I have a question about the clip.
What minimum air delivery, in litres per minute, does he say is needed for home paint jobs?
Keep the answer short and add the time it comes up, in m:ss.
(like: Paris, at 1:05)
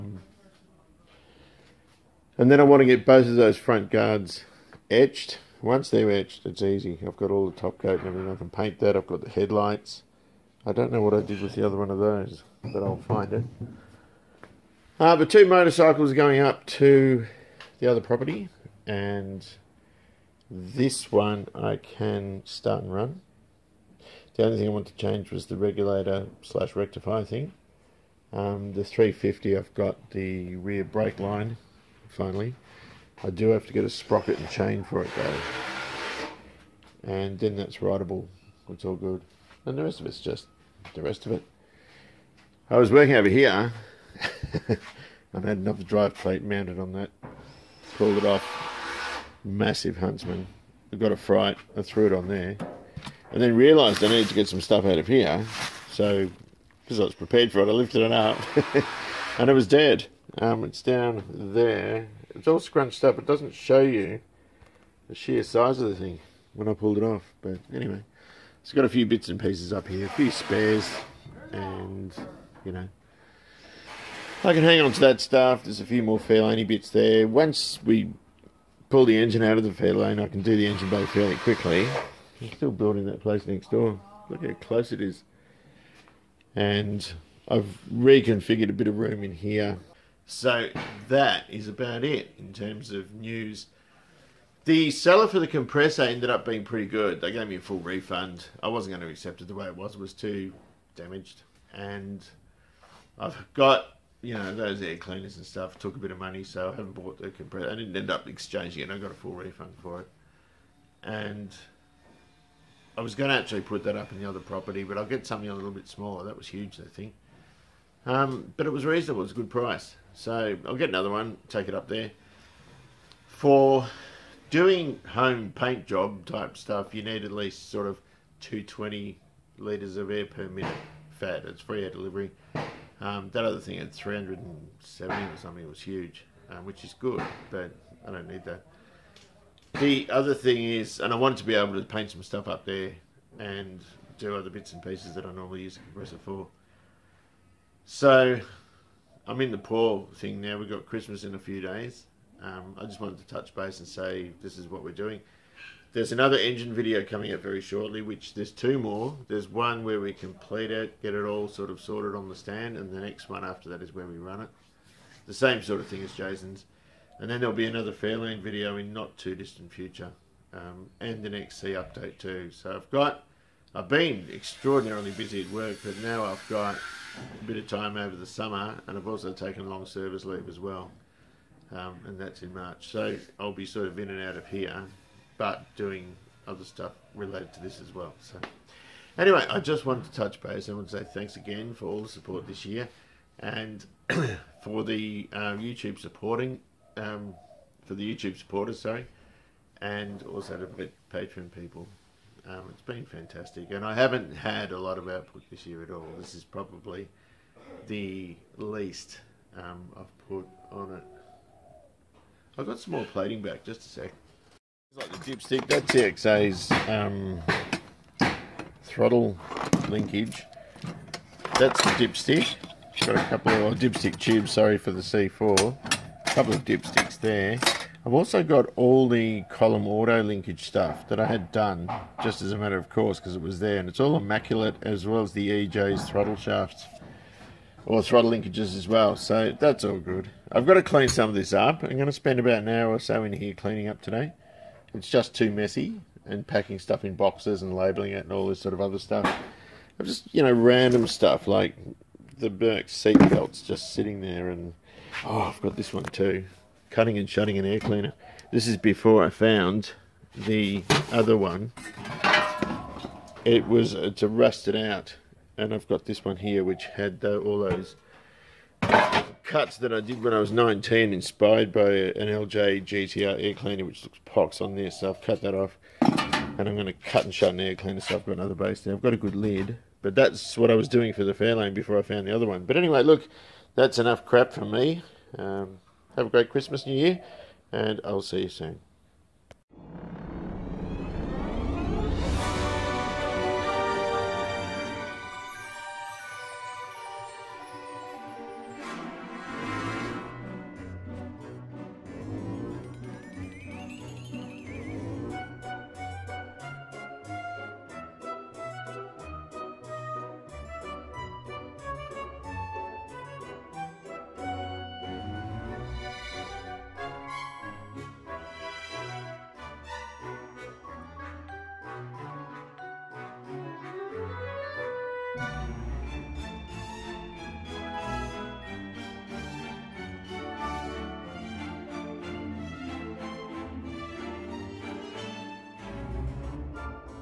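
220, at 2:08.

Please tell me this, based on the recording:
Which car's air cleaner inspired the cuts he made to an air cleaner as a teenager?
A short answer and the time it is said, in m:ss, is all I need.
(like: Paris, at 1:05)
LJ GTR, at 4:32.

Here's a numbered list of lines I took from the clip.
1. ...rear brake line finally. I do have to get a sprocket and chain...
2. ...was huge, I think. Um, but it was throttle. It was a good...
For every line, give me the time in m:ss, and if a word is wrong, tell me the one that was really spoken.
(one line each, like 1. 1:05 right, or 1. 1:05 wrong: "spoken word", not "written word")
1. 0:30 right
2. 1:56 wrong: "reasonable", not "throttle".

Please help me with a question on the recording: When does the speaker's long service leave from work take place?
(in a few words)
March.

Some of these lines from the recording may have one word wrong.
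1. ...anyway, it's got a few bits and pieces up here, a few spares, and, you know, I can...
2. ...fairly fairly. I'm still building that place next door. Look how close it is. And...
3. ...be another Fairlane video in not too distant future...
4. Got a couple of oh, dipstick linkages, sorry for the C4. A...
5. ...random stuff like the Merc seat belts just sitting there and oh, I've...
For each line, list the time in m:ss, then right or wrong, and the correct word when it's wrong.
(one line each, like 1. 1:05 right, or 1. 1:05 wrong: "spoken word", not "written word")
1. 1:07 right
2. 1:21 wrong: "quickly", not "fairly"
3. 2:47 right
4. 3:43 wrong: "tubes", not "linkages"
5. 4:10 right.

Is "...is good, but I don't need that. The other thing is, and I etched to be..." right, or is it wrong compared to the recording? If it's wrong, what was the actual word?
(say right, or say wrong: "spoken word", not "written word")
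wrong: "wanted", not "etched".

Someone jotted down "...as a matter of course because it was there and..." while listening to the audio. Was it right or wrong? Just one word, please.
right.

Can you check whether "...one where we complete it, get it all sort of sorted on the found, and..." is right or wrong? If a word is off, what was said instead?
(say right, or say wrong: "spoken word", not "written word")
wrong: "stand", not "found".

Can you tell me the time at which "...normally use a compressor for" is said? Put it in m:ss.
2:25.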